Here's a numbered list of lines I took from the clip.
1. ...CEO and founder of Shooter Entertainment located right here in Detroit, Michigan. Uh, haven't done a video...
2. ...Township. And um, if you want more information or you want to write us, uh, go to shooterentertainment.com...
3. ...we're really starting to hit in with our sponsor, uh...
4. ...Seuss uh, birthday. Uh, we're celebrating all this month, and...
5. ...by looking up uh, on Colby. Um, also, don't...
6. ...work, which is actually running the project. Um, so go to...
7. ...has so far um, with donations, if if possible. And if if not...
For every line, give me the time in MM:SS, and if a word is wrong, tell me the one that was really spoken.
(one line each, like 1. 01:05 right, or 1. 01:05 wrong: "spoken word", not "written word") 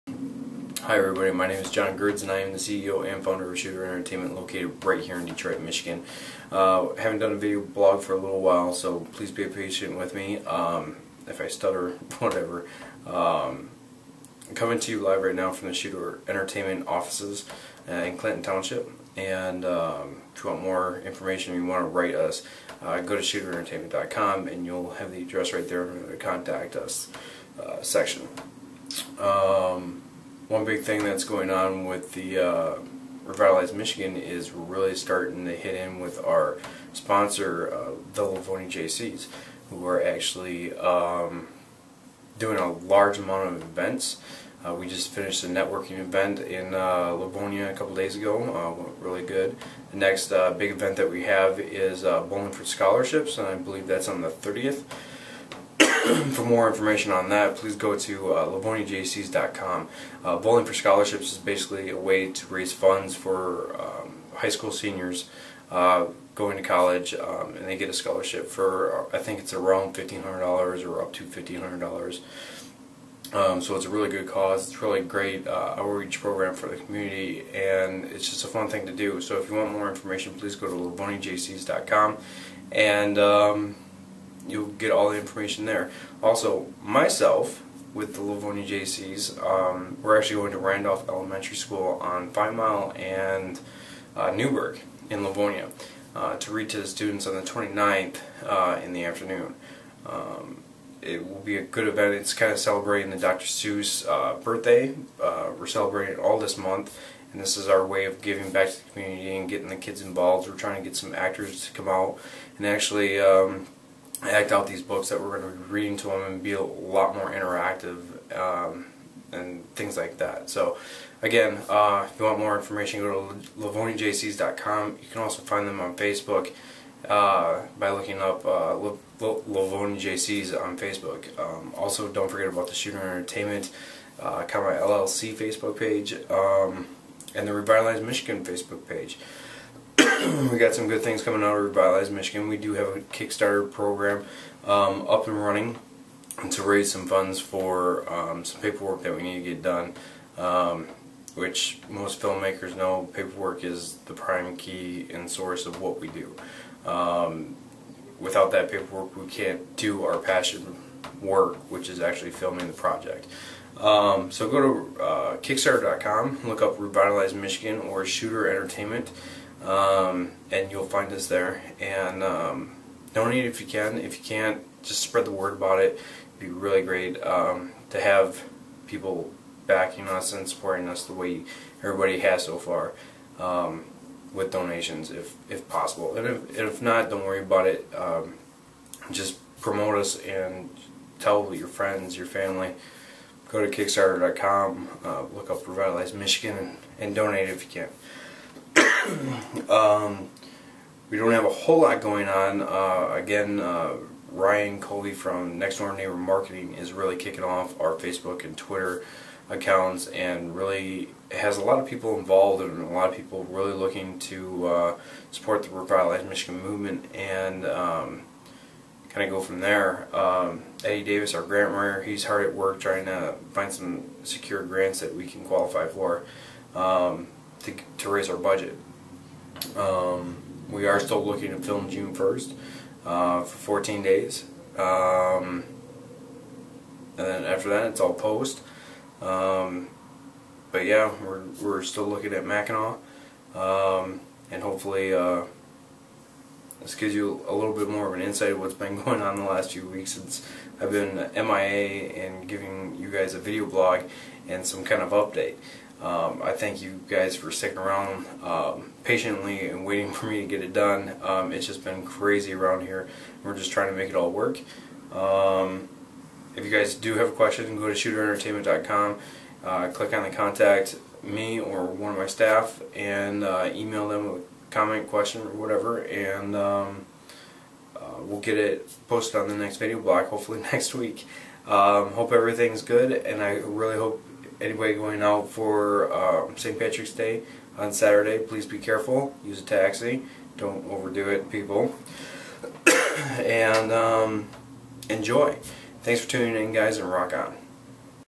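1. 00:02 right
2. 00:18 right
3. 00:34 right
4. 01:43 right
5. 02:07 wrong: "Facebook", not "Colby"
6. 02:41 wrong: "filming", not "running"
7. 03:02 right.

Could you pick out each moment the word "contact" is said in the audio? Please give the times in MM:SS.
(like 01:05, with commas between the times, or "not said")
00:26, 04:30.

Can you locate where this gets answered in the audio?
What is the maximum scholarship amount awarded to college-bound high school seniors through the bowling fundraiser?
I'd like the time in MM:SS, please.
01:11.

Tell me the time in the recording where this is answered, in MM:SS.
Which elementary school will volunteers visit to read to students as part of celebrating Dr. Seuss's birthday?
01:30.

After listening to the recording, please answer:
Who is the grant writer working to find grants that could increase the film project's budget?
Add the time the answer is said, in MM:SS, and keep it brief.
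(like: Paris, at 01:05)
Eddie Davis, at 03:40.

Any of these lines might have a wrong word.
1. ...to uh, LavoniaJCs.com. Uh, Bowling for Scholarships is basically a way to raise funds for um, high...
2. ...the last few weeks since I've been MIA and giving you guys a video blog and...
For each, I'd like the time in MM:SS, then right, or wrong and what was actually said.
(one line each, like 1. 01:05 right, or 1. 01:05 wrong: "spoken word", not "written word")
1. 00:57 right
2. 04:09 right.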